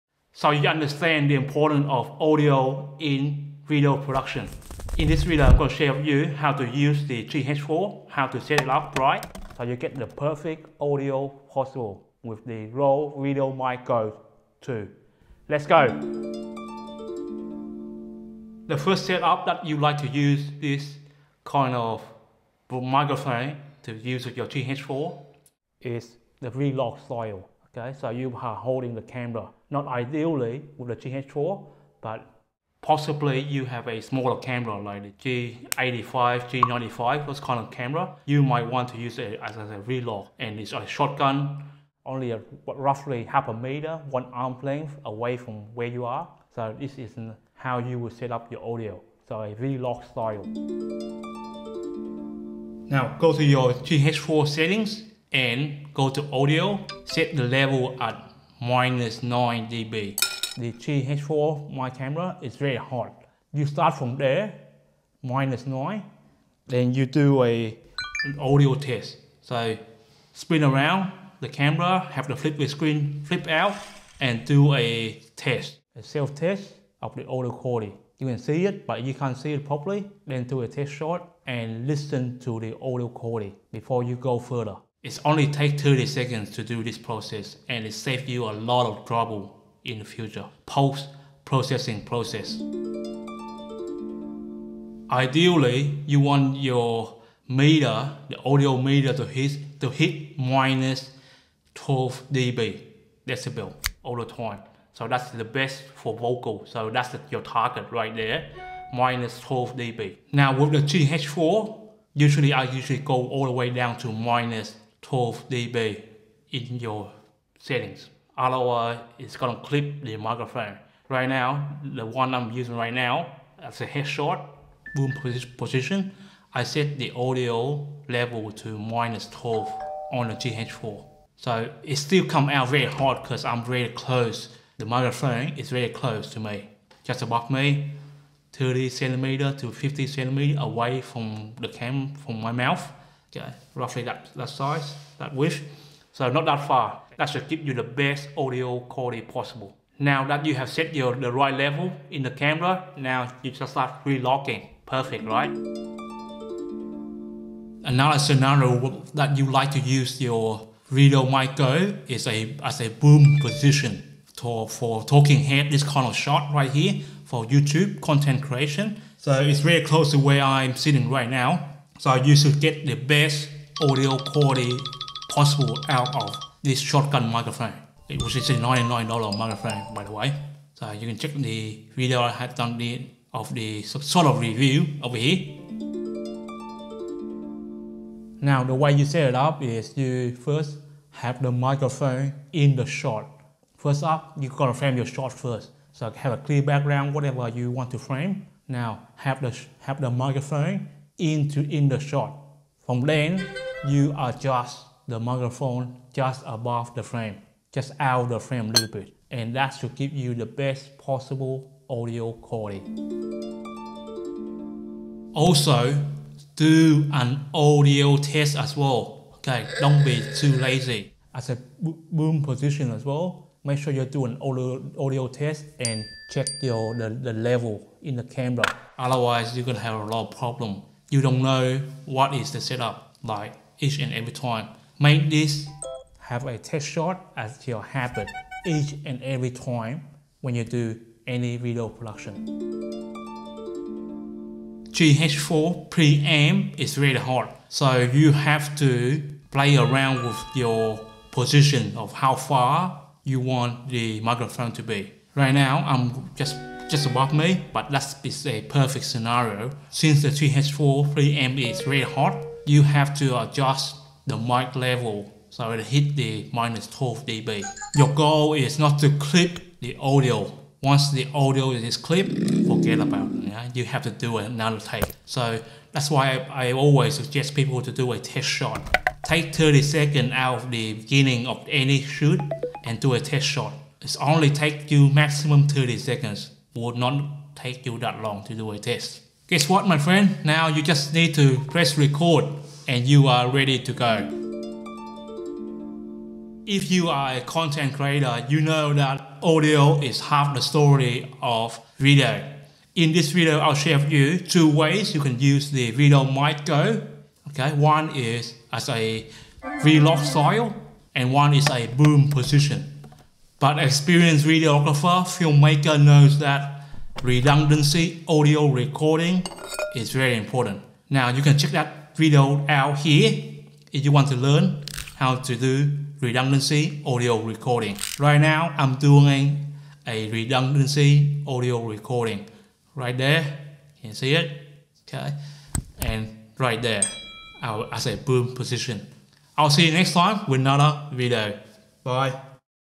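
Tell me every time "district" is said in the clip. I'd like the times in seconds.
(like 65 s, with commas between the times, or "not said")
not said.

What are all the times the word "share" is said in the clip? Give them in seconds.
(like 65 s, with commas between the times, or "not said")
5 s, 303 s.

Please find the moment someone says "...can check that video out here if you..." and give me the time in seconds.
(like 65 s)
321 s.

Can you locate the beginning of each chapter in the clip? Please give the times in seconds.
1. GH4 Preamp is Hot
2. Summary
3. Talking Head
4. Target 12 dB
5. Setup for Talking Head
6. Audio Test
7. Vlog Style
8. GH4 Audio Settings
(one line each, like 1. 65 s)
1. 243 s
2. 295 s
3. 156 s
4. 93 s
5. 186 s
6. 213 s
7. 17 s
8. 51 s.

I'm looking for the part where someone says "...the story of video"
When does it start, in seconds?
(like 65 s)
300 s.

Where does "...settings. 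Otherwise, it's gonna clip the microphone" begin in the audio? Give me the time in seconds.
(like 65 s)
117 s.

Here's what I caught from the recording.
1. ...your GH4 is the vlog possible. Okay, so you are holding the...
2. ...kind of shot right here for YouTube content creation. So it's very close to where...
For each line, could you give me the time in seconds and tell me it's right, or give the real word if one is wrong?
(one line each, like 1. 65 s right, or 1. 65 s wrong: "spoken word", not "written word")
1. 24 s wrong: "style", not "possible"
2. 165 s right.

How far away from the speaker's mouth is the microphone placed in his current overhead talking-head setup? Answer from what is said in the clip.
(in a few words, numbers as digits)
30 to 50 centimeters.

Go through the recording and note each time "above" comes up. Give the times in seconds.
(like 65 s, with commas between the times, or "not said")
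137 s, 206 s, 257 s.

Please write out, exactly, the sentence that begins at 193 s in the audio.
First up, you gotta frame your shot first.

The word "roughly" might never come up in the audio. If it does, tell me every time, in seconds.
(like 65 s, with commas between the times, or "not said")
42 s, 143 s.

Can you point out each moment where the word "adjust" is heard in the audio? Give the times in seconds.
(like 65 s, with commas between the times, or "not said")
204 s, 263 s.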